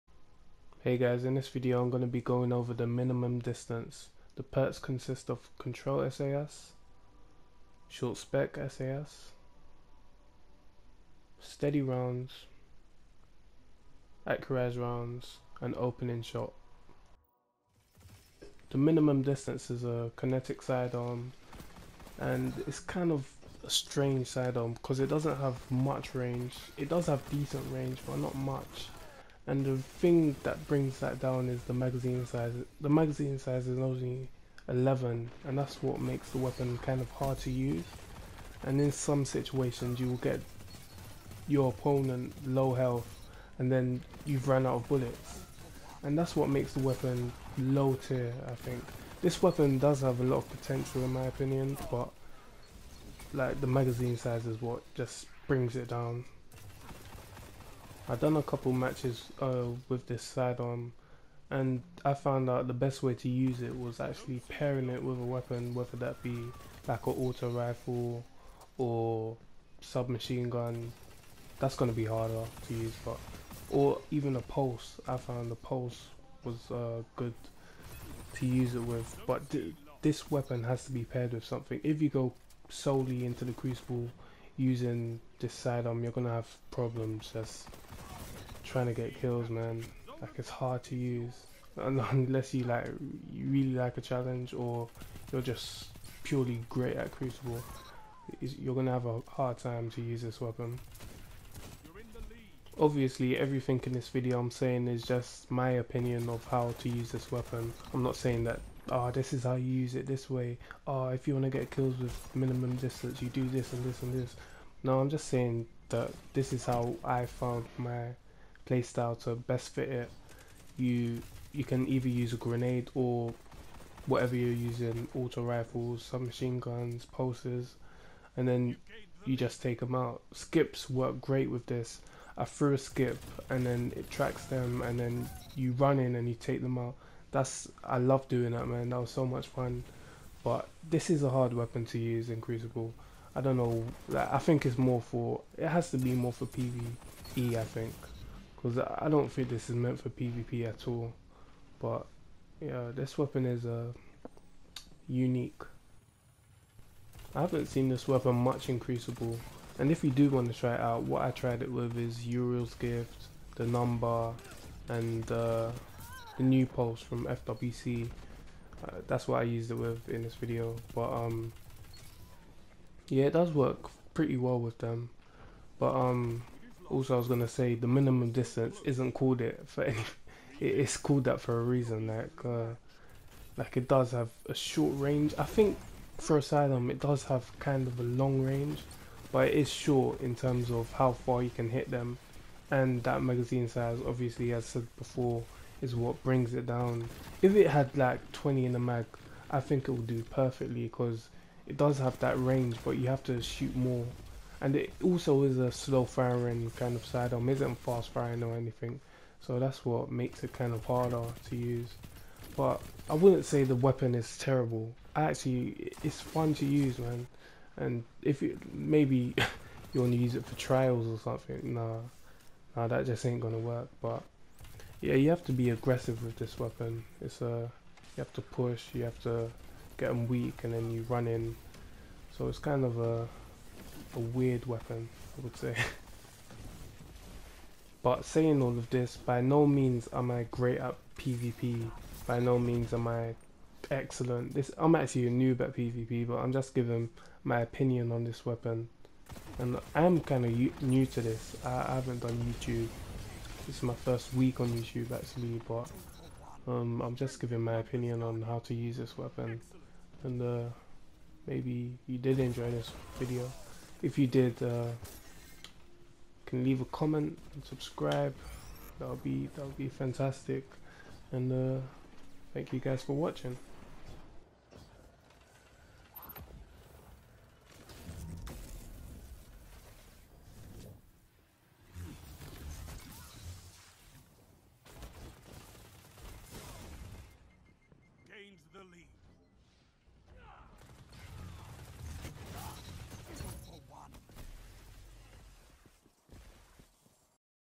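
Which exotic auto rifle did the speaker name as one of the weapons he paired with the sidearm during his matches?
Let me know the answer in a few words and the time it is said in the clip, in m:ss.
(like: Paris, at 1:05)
Uriel's Gift, at 2:42.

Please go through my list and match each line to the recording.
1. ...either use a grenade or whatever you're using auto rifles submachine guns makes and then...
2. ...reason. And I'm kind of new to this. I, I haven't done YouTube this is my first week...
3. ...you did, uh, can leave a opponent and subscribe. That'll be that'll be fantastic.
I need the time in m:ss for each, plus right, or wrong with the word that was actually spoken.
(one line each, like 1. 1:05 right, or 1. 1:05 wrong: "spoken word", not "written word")
1. 2:01 wrong: "pulses", not "makes"
2. 4:08 wrong: "weapon", not "reason"
3. 4:24 wrong: "comment", not "opponent".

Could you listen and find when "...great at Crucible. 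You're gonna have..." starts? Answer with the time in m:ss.
1:36.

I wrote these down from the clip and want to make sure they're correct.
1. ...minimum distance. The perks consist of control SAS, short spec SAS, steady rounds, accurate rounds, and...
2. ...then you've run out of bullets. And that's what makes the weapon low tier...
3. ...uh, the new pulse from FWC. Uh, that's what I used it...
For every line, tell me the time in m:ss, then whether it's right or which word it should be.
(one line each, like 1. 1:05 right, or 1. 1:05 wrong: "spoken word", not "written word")
1. 0:02 right
2. 0:43 right
3. 2:45 right.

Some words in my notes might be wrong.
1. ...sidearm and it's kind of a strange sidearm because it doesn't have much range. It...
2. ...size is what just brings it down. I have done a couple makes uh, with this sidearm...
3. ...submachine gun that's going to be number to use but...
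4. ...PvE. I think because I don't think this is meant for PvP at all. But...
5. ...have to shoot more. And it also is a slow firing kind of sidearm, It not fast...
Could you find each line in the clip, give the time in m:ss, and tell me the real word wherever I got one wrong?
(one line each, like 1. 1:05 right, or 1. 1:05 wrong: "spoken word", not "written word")
1. 0:20 right
2. 0:54 wrong: "matches", not "makes"
3. 1:09 wrong: "harder", not "number"
4. 2:26 right
5. 3:23 right.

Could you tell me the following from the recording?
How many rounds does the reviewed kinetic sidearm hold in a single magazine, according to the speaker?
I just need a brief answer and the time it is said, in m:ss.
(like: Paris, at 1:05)
11, at 0:34.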